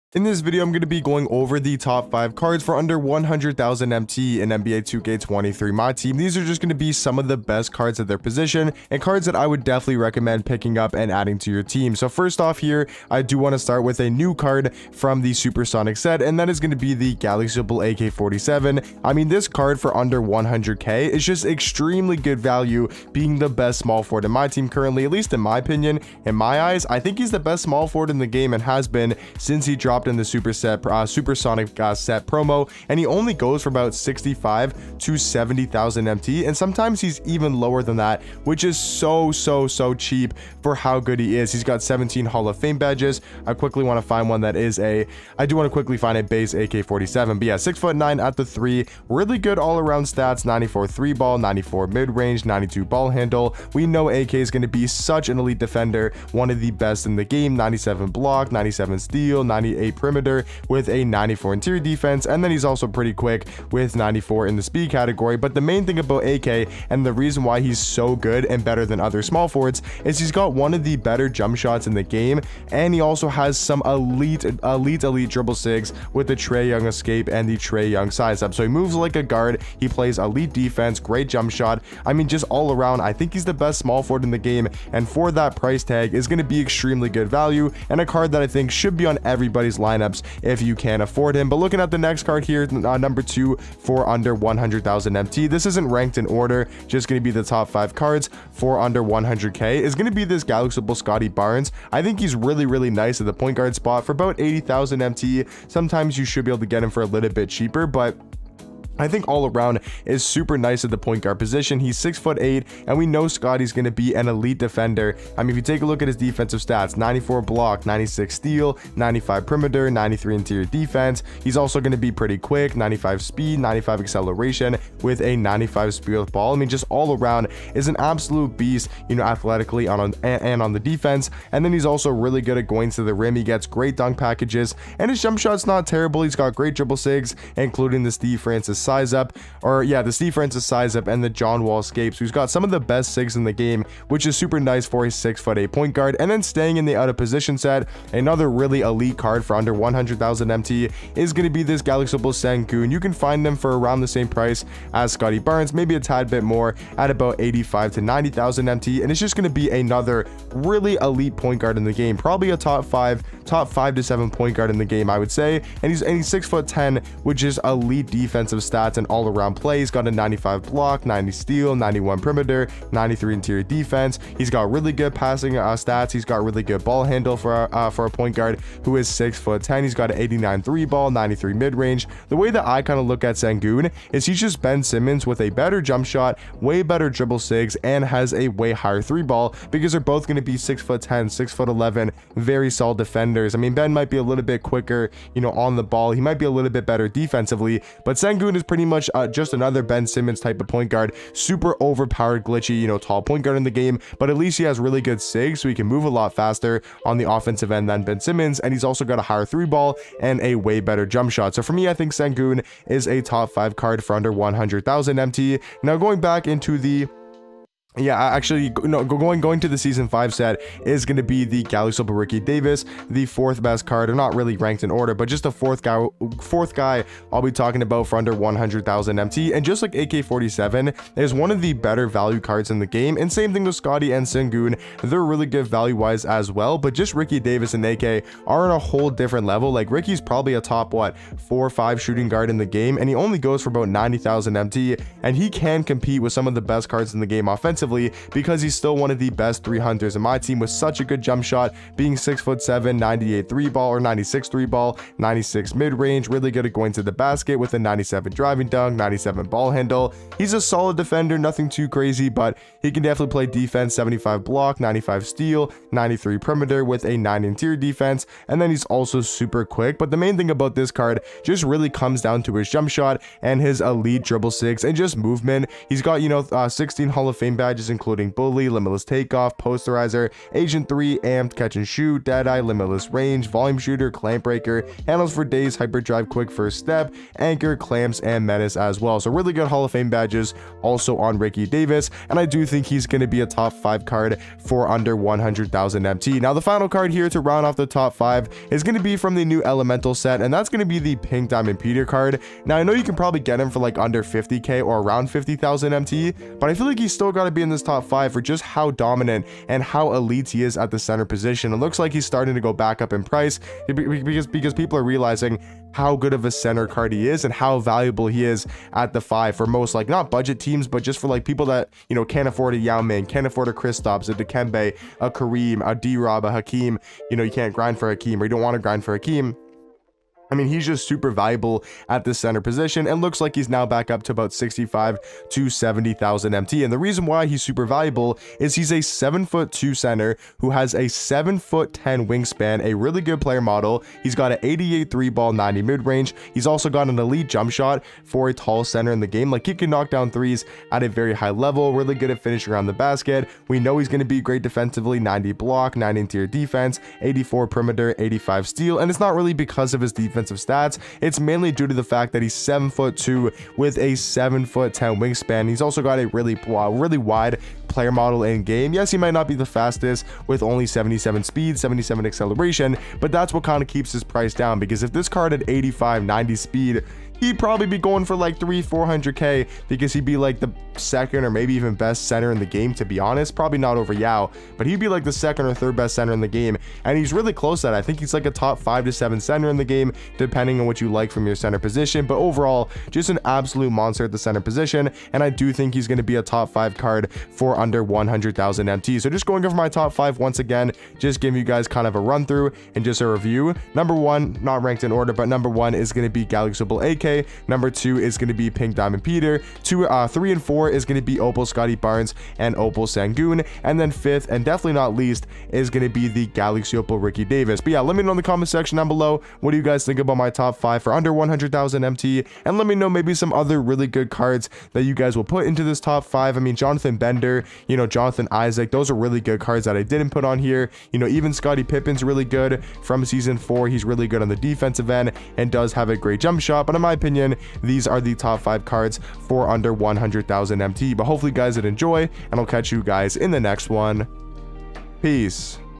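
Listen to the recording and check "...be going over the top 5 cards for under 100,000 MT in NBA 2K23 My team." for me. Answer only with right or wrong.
right.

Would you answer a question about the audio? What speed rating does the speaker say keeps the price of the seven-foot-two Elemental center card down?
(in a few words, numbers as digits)
77.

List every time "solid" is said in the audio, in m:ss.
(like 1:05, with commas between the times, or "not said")
3:12, 4:20.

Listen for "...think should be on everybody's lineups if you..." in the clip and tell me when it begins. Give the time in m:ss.
1:28.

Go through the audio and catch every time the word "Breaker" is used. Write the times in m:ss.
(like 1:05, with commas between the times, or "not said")
4:44.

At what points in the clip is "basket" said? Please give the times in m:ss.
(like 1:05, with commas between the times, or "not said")
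4:17, 5:52.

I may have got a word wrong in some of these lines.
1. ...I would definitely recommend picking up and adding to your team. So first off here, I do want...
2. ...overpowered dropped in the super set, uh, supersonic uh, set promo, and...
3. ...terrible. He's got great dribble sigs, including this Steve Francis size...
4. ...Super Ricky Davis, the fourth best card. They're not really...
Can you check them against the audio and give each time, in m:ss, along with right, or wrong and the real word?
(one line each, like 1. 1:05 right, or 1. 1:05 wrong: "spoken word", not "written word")
1. 0:09 right
2. 0:29 wrong: "dropped", not "overpowered"
3. 2:15 right
4. 3:41 right.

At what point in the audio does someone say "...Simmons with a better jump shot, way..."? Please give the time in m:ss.
3:04.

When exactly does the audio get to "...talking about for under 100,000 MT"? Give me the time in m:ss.
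3:47.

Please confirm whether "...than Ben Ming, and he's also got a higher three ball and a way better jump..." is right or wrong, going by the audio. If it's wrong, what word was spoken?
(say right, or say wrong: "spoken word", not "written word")
wrong: "Simmons", not "Ming".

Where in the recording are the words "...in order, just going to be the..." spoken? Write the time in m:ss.
1:36.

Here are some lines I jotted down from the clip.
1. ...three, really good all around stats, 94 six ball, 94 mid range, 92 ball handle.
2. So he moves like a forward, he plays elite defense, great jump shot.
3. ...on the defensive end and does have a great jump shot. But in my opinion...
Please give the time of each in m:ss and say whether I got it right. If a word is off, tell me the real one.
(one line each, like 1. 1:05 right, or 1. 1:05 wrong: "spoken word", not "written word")
1. 0:48 wrong: "three", not "six"
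2. 1:18 wrong: "guard", not "forward"
3. 7:14 right.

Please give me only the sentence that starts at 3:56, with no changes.
But just Ricky Davis and AK are on a whole different level.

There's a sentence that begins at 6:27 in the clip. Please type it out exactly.
And he's really close to that.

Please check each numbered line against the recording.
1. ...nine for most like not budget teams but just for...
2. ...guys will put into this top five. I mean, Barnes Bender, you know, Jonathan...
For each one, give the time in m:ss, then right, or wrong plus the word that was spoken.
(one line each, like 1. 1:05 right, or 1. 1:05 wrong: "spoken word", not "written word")
1. 5:19 wrong: "five", not "nine"
2. 7:05 wrong: "Jonathan", not "Barnes".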